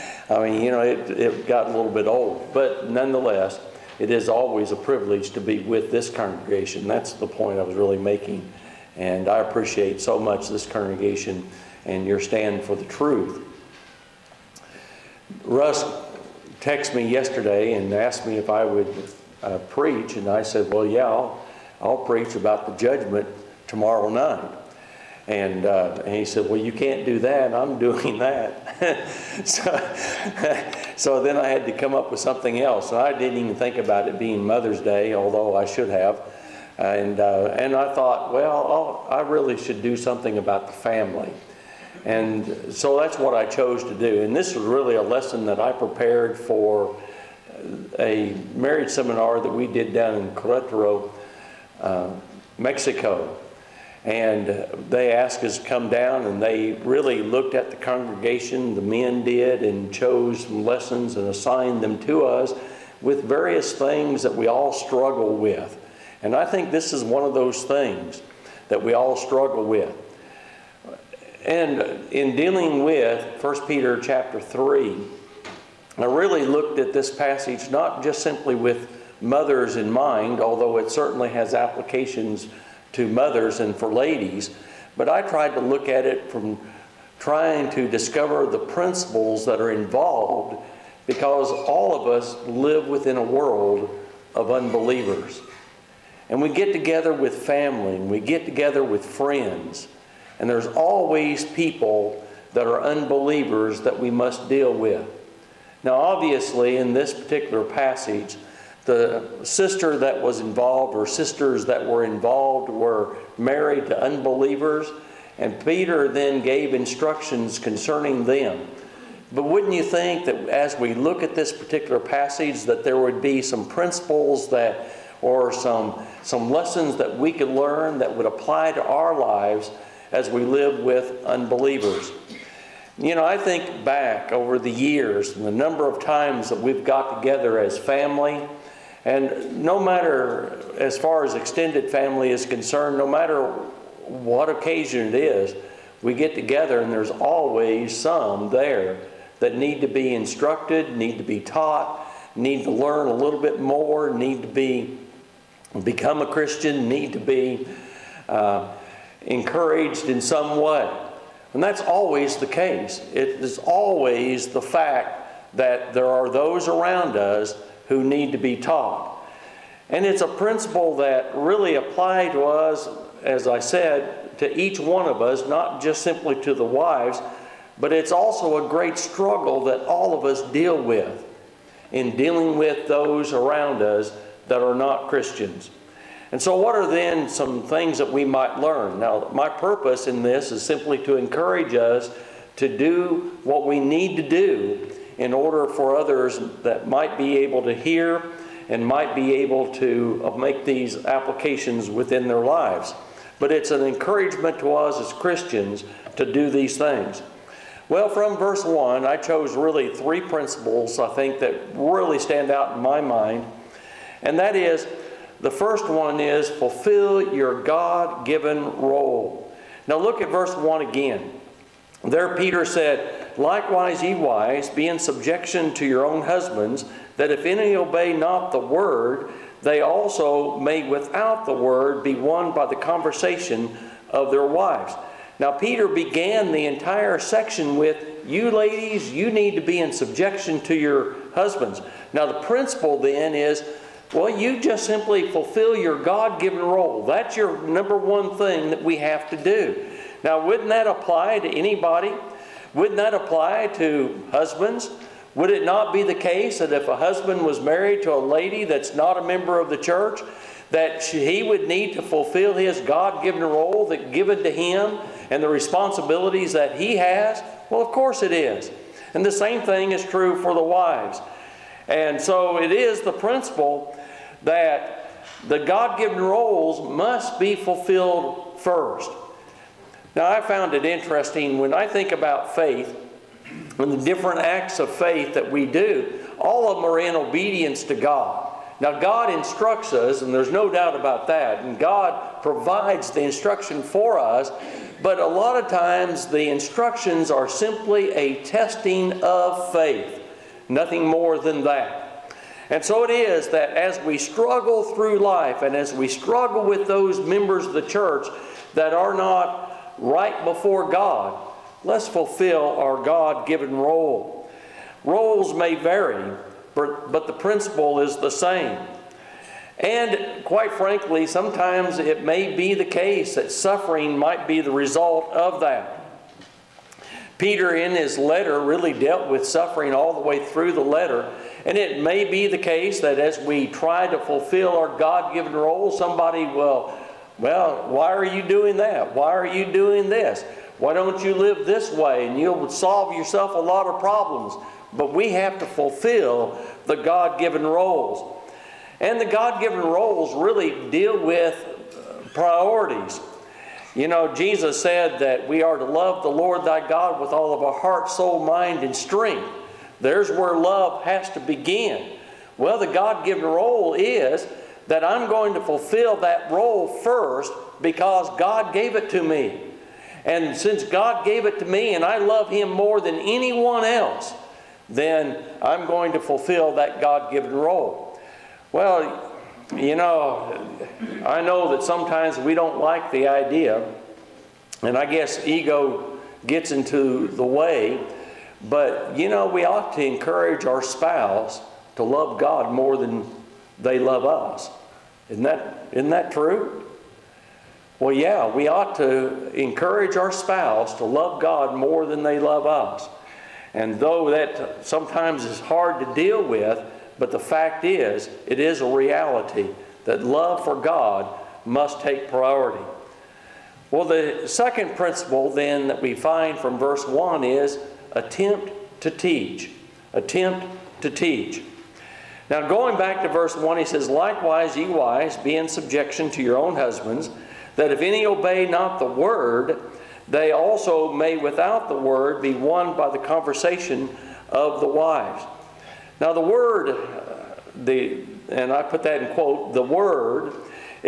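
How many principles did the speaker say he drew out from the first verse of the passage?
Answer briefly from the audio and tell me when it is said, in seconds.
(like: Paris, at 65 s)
3, at 209 s.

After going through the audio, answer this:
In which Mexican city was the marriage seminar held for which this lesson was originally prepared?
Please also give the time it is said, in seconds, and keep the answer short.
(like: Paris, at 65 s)
Querétaro, at 50 s.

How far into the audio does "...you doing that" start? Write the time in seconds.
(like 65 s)
338 s.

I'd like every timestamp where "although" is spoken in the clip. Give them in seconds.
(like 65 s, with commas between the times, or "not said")
35 s, 80 s.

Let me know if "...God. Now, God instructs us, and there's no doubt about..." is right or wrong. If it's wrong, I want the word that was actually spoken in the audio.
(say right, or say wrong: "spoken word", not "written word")
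right.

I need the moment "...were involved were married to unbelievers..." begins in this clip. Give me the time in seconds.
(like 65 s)
111 s.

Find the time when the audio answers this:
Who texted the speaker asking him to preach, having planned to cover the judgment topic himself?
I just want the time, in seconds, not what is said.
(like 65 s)
15 s.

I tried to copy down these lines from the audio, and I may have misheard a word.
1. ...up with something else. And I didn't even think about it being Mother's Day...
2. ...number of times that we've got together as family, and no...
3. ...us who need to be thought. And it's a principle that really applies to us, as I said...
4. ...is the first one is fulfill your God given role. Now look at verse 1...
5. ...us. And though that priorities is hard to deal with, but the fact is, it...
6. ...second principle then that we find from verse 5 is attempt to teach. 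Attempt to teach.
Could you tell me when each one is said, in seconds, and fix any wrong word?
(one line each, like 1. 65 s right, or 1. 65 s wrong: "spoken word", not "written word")
1. 31 s right
2. 135 s right
3. 167 s wrong: "taught", not "thought"
4. 214 s right
5. 402 s wrong: "sometimes", not "priorities"
6. 414 s wrong: "1", not "5".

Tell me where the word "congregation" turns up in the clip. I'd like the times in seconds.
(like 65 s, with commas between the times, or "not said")
6 s, 10 s, 57 s.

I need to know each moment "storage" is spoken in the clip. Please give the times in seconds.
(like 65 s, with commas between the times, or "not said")
not said.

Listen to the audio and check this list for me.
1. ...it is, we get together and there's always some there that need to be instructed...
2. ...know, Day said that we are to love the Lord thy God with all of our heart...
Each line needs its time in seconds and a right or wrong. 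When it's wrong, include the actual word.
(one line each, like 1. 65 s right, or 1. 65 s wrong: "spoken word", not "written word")
1. 145 s right
2. 354 s wrong: "Jesus", not "Day".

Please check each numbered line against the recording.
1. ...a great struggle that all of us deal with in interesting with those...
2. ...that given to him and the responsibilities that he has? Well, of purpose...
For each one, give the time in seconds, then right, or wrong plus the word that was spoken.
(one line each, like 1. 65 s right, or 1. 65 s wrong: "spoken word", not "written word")
1. 178 s wrong: "dealing", not "interesting"
2. 263 s wrong: "course", not "purpose".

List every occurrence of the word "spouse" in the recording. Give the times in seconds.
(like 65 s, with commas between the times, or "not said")
390 s, 400 s.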